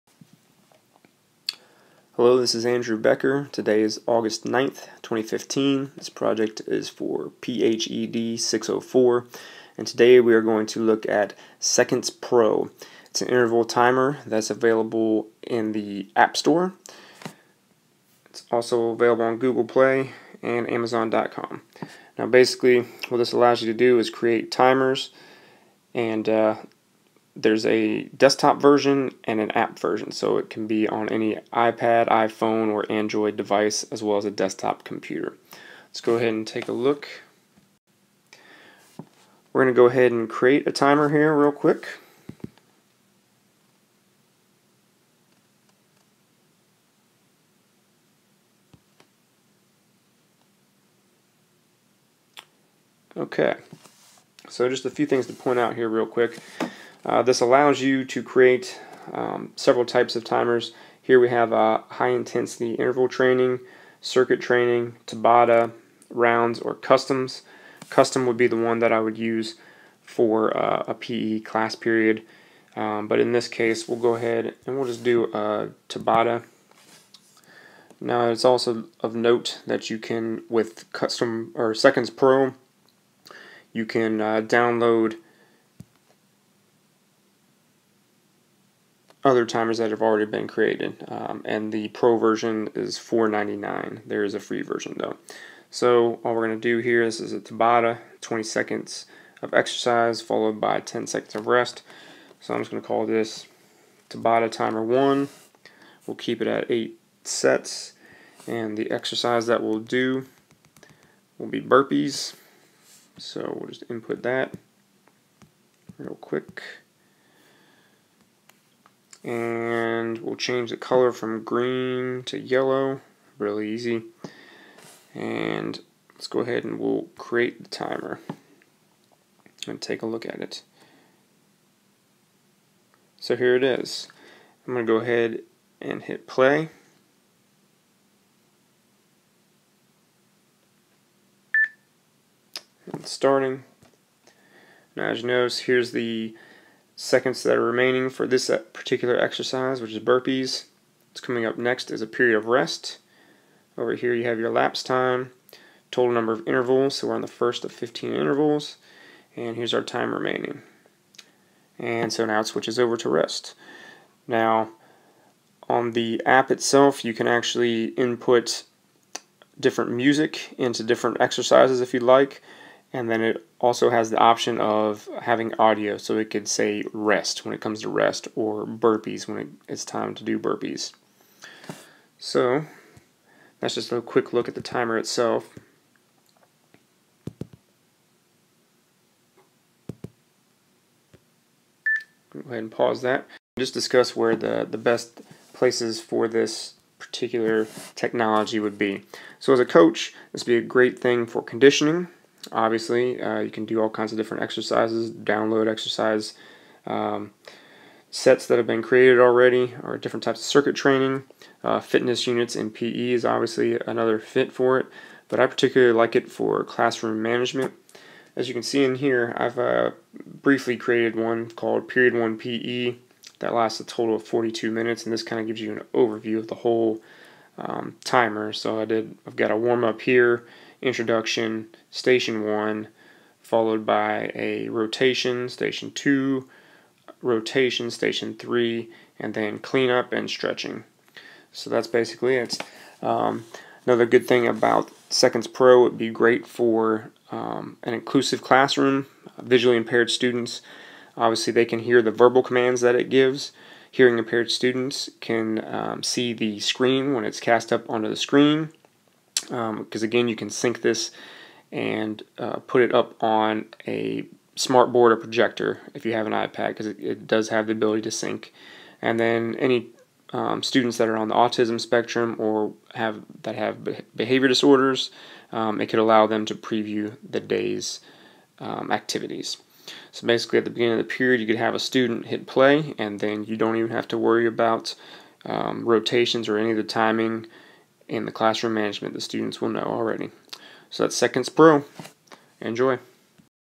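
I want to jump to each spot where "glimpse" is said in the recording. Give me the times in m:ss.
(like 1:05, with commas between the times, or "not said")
not said.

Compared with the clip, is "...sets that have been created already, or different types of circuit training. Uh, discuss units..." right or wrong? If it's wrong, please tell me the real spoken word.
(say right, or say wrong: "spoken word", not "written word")
wrong: "fitness", not "discuss".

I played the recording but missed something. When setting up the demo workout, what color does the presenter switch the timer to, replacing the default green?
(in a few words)
Yellow.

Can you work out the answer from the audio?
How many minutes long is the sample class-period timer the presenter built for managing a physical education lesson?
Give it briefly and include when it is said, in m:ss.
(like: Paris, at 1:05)
42, at 3:44.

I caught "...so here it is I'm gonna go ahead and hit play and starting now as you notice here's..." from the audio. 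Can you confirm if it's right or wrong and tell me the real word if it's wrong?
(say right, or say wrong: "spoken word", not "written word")
right.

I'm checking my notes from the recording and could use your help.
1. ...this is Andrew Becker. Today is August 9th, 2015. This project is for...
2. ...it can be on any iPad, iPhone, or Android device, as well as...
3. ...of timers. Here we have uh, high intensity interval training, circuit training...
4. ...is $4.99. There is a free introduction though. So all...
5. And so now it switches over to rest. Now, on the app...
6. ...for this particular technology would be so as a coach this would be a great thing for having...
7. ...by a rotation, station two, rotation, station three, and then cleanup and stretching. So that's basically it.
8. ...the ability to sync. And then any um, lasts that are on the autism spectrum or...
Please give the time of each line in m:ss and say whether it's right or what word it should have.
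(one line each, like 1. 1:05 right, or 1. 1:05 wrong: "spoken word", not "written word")
1. 0:02 right
2. 0:30 right
3. 1:00 right
4. 1:32 wrong: "version", not "introduction"
5. 2:41 right
6. 3:16 wrong: "conditioning", not "having"
7. 3:53 right
8. 4:27 wrong: "students", not "lasts".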